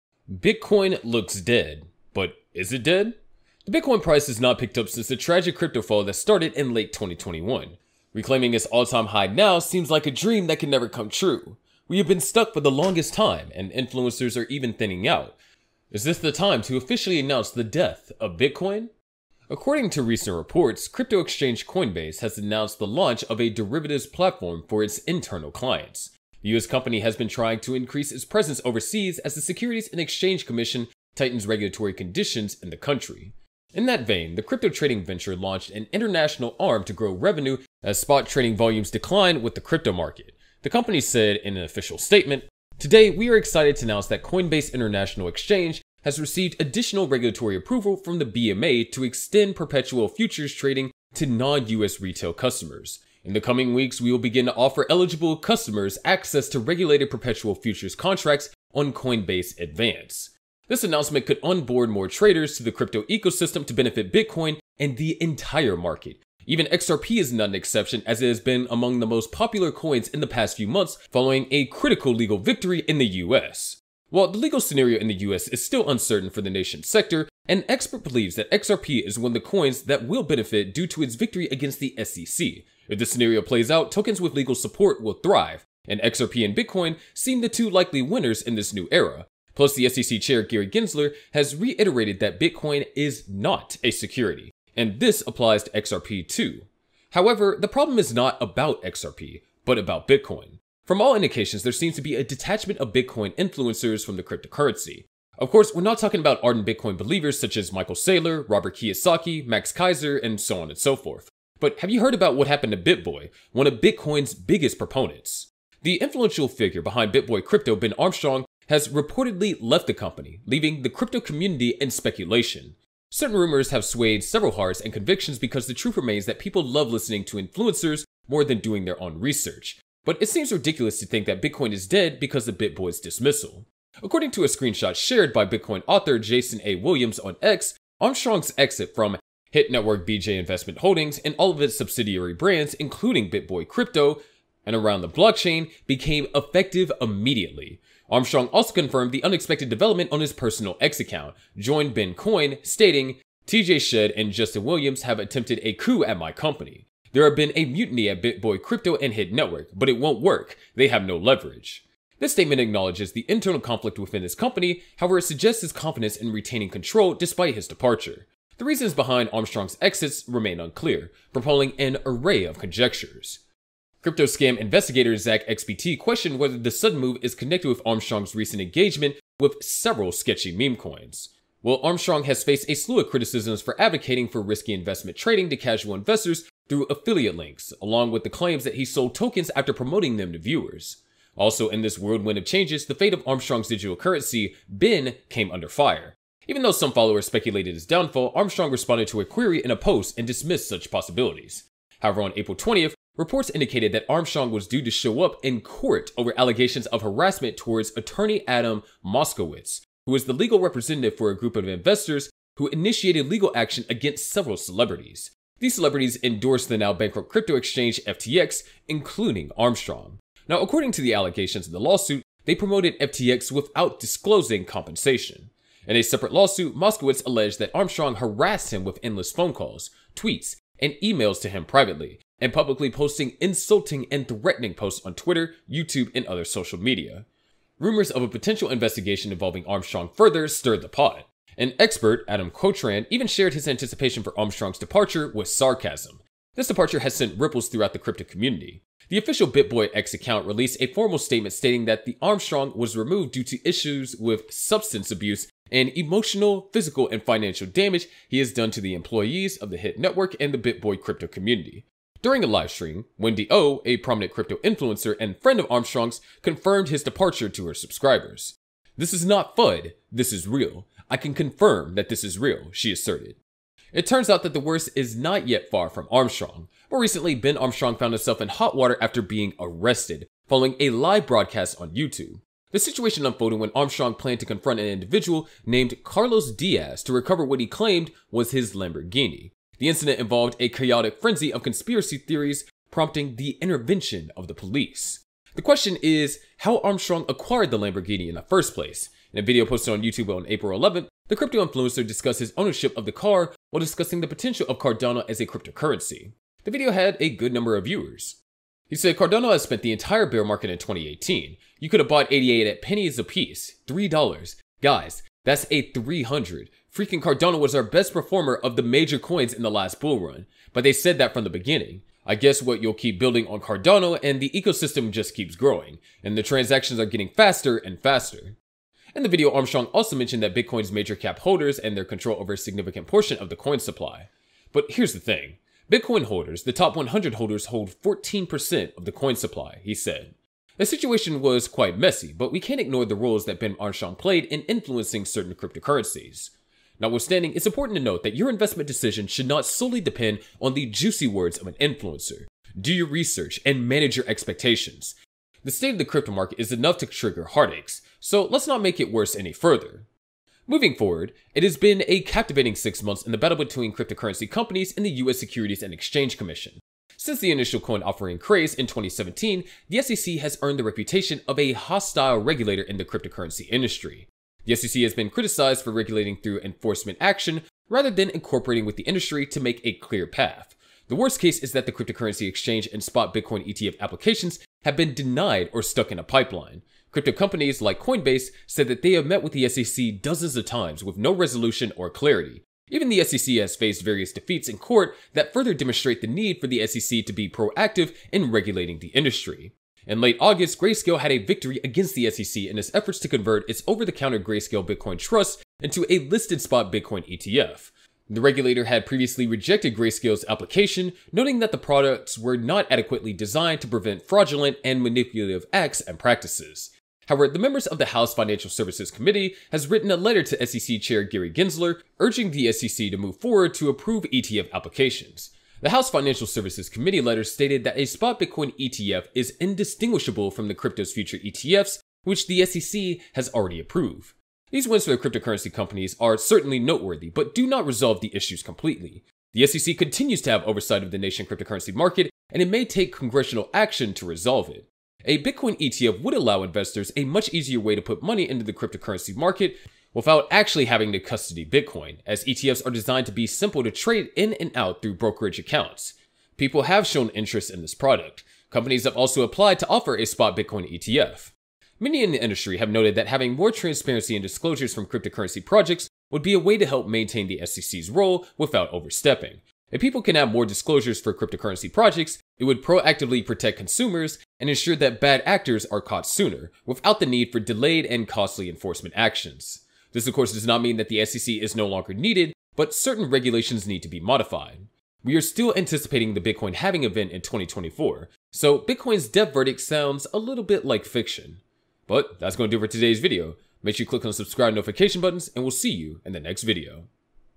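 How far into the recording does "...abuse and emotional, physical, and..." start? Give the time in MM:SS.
04:15.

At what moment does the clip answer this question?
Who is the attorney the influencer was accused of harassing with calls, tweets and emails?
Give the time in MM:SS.
03:28.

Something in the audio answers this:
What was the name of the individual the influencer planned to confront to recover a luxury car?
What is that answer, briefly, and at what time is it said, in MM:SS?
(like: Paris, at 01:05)
Carlos Diaz, at 04:46.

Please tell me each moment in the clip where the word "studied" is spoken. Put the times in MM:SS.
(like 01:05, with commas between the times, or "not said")
not said.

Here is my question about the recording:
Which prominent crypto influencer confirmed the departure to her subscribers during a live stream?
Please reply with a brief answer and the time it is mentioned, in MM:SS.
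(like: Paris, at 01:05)
Wendy O, at 04:23.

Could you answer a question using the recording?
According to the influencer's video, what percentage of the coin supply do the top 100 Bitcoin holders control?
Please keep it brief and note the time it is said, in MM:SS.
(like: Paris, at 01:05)
14%, at 05:38.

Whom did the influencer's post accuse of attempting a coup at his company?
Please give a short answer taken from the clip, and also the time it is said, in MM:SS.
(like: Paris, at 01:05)
TJ Shedd, at 02:33.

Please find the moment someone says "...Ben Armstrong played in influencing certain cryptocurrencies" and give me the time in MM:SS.
05:43.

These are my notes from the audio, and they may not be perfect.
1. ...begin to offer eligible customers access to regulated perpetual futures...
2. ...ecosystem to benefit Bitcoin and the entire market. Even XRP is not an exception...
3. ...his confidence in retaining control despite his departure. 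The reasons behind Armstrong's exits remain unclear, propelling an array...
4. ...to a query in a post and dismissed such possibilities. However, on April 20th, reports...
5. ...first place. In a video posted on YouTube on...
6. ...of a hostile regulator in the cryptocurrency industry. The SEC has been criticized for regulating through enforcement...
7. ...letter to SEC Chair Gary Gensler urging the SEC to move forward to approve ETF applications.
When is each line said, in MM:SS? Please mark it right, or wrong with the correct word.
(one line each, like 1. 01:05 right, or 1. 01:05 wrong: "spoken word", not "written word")
1. 00:54 right
2. 01:03 right
3. 02:45 right
4. 03:19 right
5. 04:58 right
6. 06:11 right
7. 07:00 right.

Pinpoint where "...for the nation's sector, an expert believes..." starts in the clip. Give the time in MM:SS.
01:16.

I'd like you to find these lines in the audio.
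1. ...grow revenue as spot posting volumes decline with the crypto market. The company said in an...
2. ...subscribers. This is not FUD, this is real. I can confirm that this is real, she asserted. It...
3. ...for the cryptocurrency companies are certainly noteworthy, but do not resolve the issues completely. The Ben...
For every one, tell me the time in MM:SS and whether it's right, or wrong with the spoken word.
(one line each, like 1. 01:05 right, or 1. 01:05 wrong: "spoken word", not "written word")
1. 00:36 wrong: "trading", not "posting"
2. 04:27 right
3. 07:15 wrong: "SEC", not "Ben".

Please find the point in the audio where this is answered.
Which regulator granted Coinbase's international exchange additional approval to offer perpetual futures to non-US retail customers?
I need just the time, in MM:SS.
00:48.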